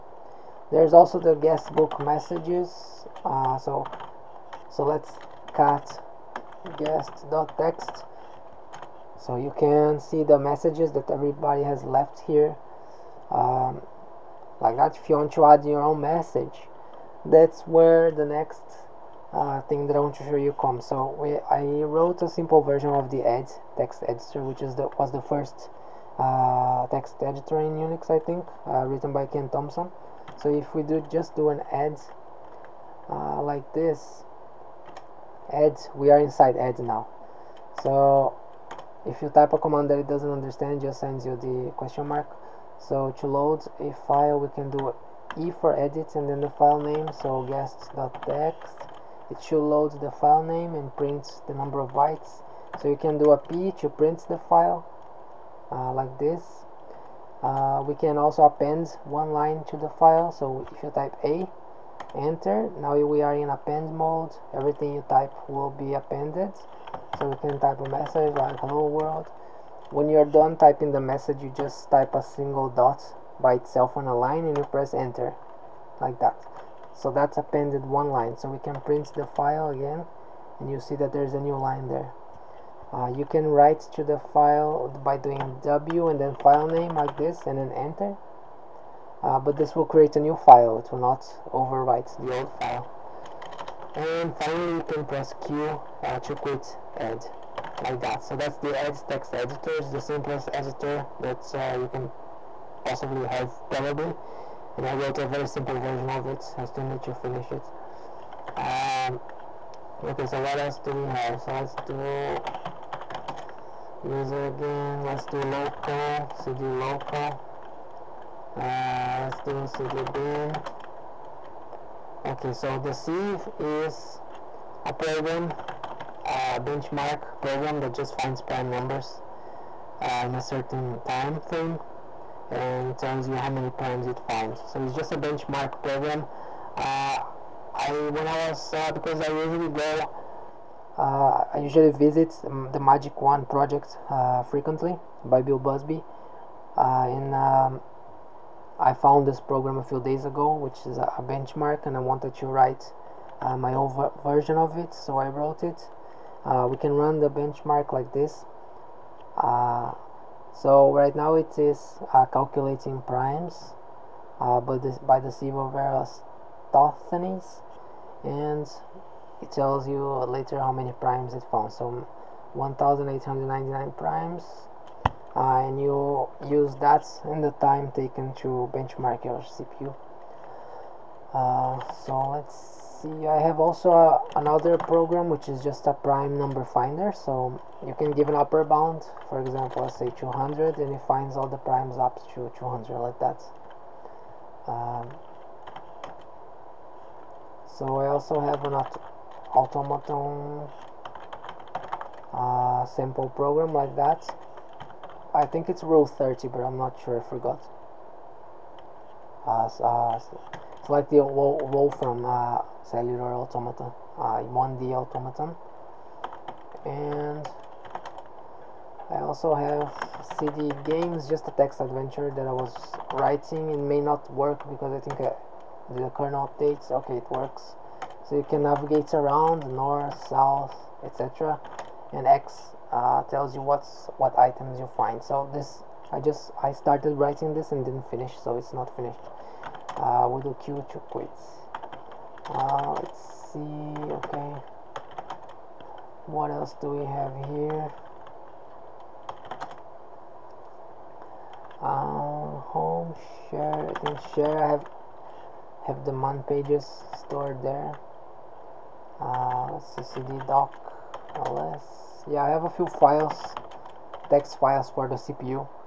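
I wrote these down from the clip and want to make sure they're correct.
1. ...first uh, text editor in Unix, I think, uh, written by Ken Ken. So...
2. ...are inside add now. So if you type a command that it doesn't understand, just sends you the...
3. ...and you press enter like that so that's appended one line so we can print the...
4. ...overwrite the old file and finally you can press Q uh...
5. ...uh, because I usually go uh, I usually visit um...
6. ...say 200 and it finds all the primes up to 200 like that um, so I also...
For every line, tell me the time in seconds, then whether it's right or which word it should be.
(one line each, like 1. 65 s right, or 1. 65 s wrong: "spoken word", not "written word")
1. 25 s wrong: "Thompson", not "Ken"
2. 36 s right
3. 74 s right
4. 91 s right
5. 138 s right
6. 189 s right.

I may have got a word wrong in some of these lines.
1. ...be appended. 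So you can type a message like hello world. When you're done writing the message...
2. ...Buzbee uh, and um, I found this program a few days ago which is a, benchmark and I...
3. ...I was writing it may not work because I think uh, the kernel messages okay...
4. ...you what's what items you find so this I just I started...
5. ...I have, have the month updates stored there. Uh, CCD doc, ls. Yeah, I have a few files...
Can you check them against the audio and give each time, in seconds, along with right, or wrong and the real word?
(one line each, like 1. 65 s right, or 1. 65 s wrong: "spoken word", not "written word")
1. 65 s wrong: "typing", not "writing"
2. 145 s right
3. 222 s wrong: "updates", not "messages"
4. 233 s right
5. 254 s wrong: "pages", not "updates".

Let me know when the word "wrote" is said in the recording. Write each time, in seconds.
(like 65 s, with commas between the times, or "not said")
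21 s, 104 s, 155 s.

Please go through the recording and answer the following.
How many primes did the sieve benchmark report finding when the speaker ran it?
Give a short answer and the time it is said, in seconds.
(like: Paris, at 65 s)
1899, at 172 s.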